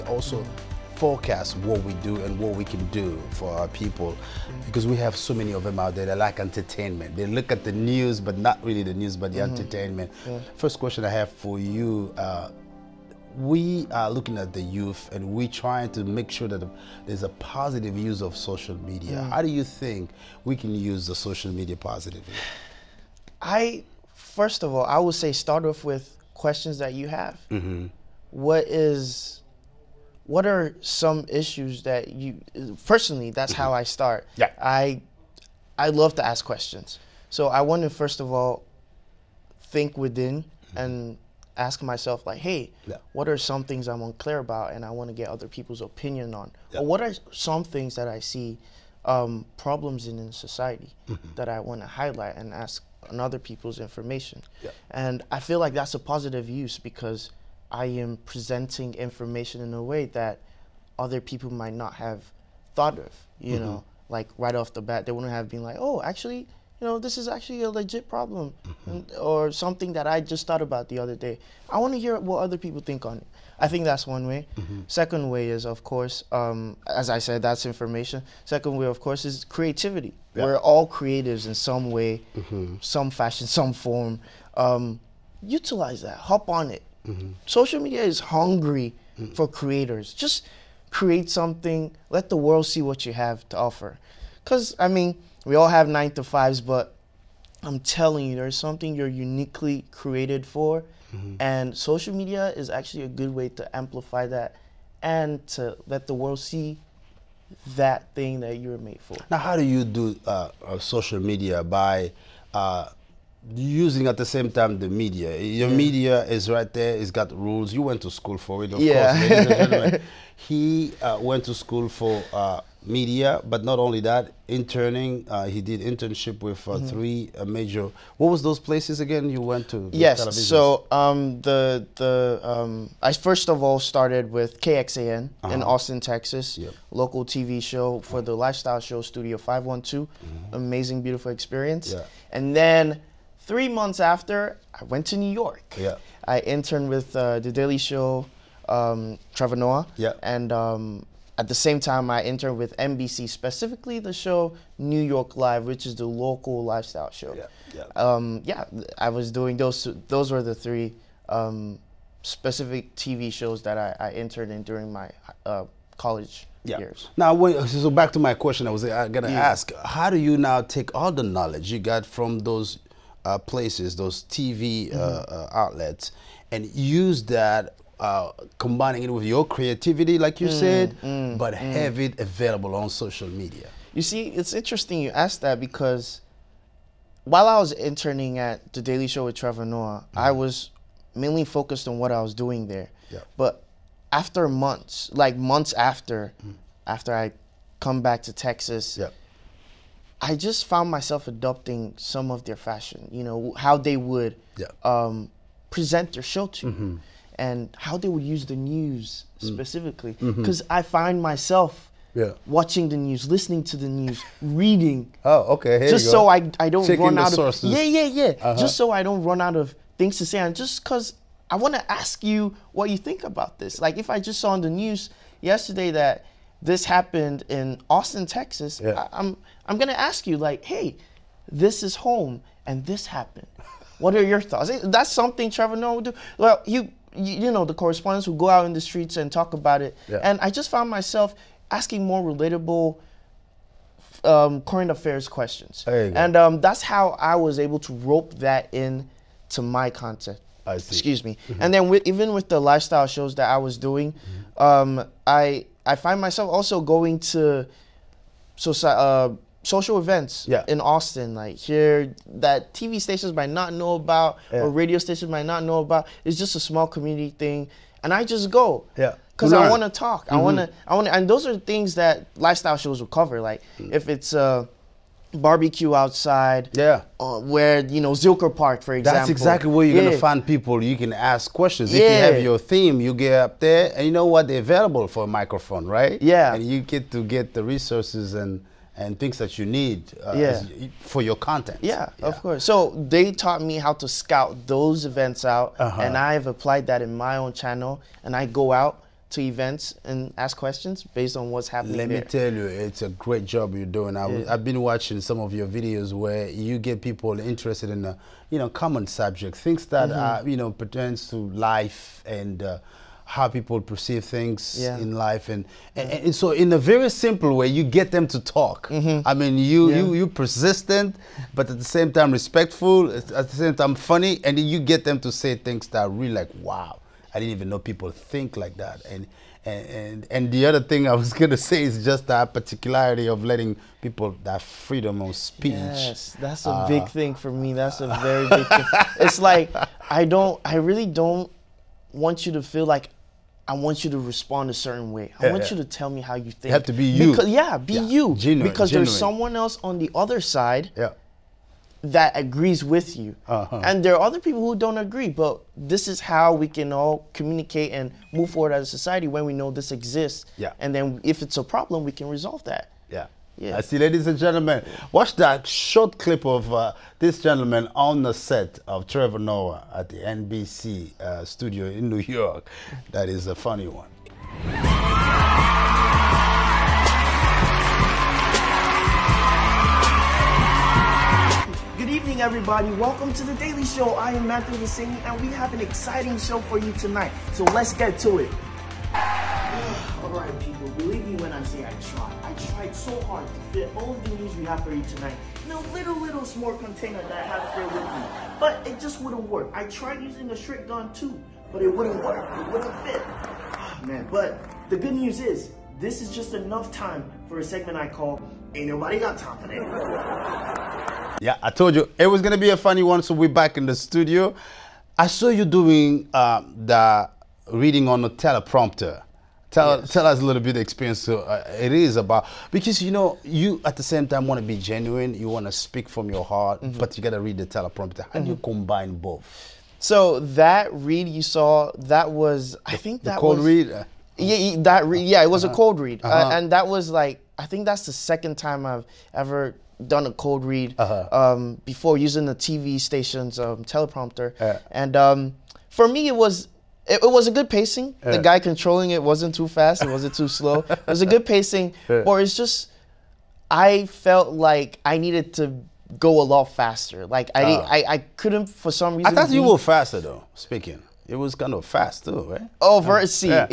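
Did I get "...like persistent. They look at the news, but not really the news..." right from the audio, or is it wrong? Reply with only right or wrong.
wrong.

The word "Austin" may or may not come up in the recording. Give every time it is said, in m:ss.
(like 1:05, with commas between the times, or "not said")
2:15, 3:47, 4:20.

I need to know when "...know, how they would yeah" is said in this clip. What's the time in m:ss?
3:23.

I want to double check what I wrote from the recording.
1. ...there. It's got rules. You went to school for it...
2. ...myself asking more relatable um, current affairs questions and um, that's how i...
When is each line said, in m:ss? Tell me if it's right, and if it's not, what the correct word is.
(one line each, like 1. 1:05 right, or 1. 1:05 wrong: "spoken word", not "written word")
1. 1:56 right
2. 4:00 right.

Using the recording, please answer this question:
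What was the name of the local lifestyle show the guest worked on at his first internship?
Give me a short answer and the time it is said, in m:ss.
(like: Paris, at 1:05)
Studio Five One Two, at 2:19.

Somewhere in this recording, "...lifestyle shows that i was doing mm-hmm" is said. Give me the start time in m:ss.
4:12.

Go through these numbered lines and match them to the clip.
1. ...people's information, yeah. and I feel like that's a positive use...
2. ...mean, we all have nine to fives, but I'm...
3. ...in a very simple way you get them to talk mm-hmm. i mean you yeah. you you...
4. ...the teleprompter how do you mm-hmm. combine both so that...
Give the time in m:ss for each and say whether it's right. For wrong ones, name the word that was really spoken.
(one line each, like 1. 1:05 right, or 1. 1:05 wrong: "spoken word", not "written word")
1. 0:53 right
2. 1:34 right
3. 5:16 right
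4. 7:07 right.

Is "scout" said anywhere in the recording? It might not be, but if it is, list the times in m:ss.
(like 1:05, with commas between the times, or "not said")
4:54.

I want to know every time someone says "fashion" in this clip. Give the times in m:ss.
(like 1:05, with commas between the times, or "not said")
1:23, 3:22.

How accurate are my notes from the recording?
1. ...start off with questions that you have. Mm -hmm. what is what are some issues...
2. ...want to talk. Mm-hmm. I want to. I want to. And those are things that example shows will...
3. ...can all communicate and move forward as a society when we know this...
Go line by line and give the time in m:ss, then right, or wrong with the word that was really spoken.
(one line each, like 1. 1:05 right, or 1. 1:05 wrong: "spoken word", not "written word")
1. 0:25 right
2. 4:29 wrong: "lifestyle", not "example"
3. 5:56 right.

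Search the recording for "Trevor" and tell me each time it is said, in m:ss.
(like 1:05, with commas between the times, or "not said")
2:29, 3:09, 3:55, 6:09.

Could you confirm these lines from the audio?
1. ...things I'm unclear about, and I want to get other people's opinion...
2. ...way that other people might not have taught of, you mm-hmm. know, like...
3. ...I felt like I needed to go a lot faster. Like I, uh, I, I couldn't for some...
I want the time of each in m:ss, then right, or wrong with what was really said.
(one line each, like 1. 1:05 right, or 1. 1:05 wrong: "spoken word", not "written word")
1. 0:43 right
2. 0:59 wrong: "thought", not "taught"
3. 7:33 right.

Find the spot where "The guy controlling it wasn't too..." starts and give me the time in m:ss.
7:28.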